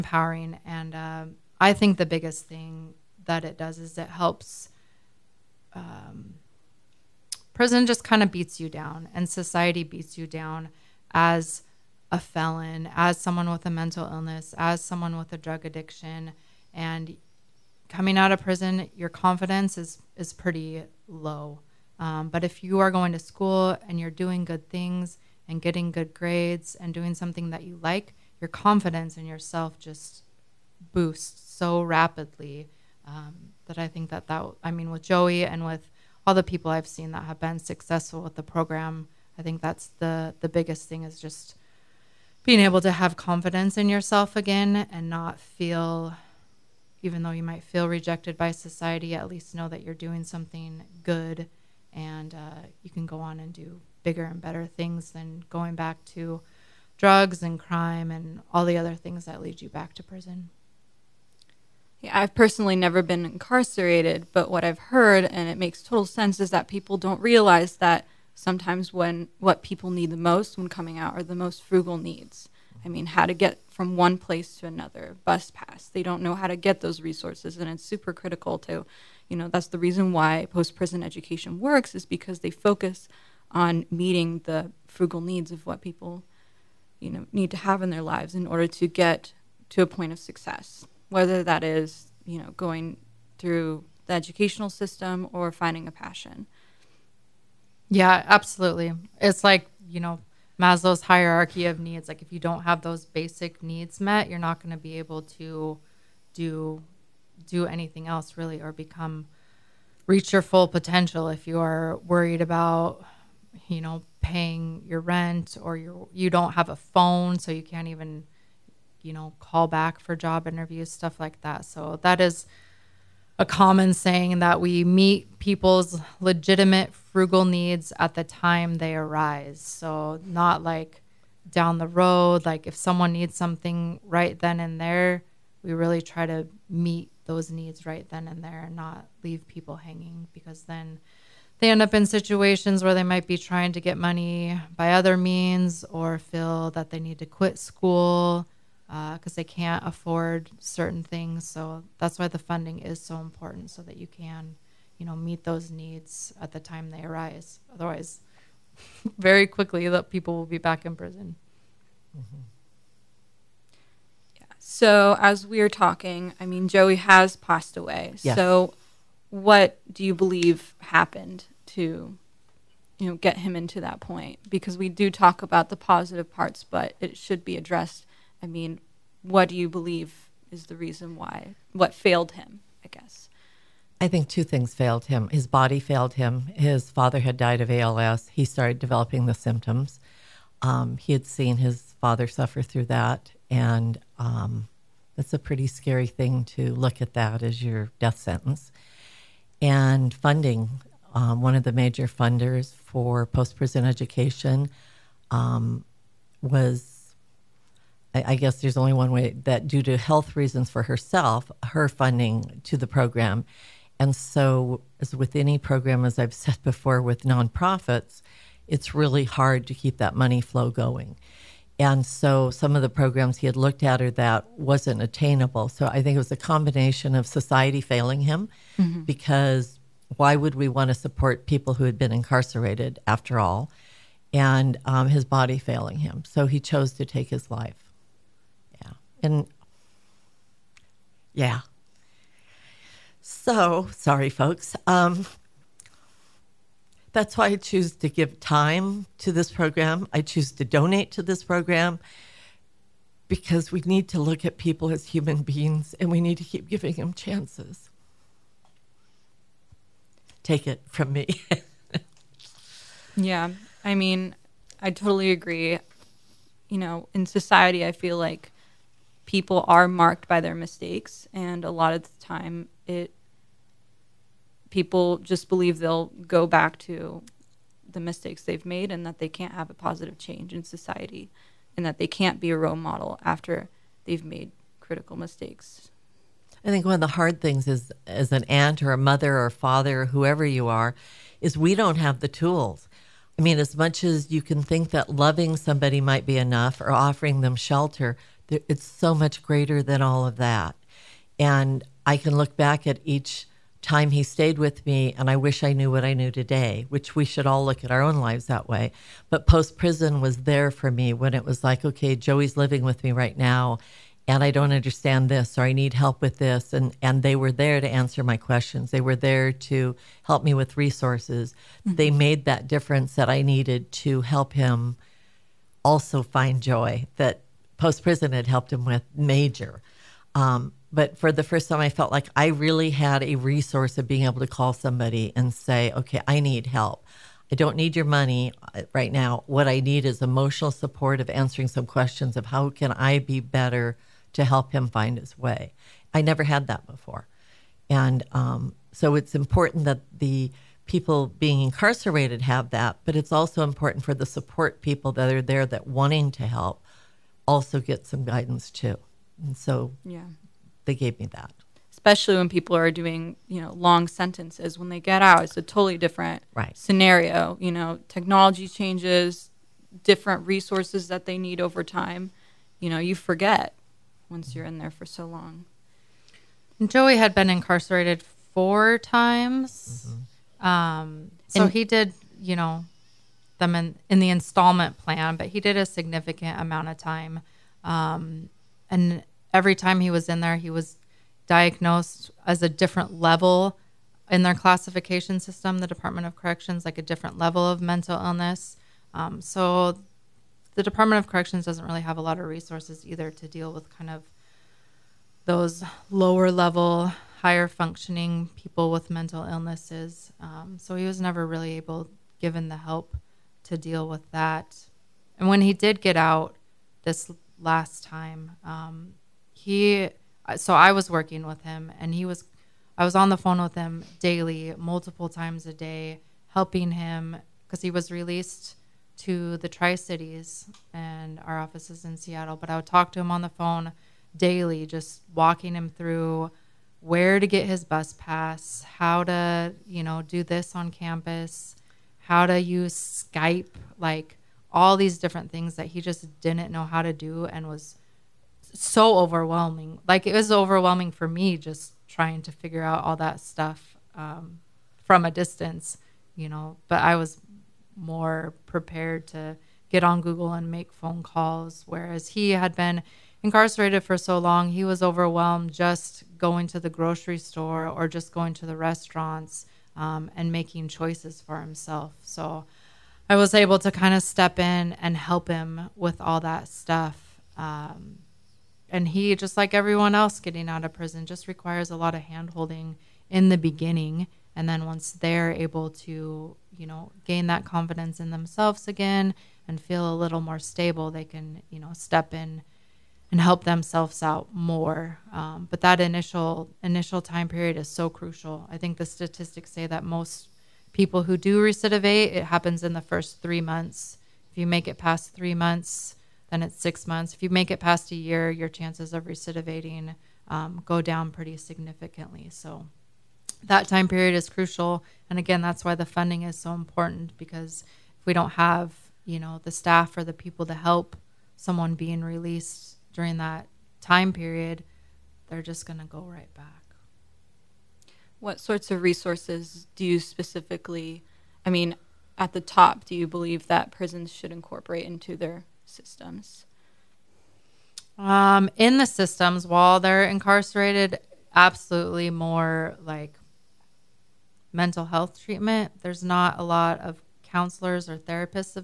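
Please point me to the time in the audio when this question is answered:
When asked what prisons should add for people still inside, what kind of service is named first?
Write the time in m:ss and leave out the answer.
9:04.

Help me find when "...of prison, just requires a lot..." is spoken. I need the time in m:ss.
8:00.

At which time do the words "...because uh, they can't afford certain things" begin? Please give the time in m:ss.
2:28.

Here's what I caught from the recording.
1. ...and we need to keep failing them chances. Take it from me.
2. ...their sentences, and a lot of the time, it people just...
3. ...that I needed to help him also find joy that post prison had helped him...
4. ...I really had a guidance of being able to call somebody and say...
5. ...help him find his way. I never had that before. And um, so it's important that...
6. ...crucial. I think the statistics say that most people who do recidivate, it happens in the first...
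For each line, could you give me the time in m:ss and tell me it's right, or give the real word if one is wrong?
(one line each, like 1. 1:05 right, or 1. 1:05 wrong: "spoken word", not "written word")
1. 4:15 wrong: "giving", not "failing"
2. 4:30 wrong: "mistakes", not "sentences"
3. 5:23 right
4. 5:32 wrong: "resource", not "guidance"
5. 5:44 right
6. 8:18 right.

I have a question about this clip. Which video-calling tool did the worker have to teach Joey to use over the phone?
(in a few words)
Skype.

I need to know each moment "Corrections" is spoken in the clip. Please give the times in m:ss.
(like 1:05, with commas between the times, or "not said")
6:36, 6:41.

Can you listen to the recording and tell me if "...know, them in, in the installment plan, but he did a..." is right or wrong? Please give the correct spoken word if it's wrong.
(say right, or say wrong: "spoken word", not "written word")
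right.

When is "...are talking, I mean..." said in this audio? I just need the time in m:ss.
2:45.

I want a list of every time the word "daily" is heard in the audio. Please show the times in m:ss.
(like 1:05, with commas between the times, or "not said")
7:04, 7:14.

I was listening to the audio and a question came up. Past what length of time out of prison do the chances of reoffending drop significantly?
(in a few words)
a year.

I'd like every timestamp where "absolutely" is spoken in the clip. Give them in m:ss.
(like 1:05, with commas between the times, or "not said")
1:38, 9:01.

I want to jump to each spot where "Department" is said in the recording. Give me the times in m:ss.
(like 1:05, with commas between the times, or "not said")
6:35, 6:40.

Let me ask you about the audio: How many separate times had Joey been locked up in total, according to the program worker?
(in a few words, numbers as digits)
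4.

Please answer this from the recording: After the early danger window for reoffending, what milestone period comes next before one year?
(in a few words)
6 months.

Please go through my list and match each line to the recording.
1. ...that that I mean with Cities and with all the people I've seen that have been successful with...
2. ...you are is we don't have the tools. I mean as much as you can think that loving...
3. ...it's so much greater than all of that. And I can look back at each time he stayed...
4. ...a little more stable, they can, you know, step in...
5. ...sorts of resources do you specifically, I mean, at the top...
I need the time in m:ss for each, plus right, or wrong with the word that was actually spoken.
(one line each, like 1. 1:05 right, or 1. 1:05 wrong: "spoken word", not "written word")
1. 0:34 wrong: "Joey", not "Cities"
2. 4:50 right
3. 4:58 right
4. 8:10 right
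5. 8:48 right.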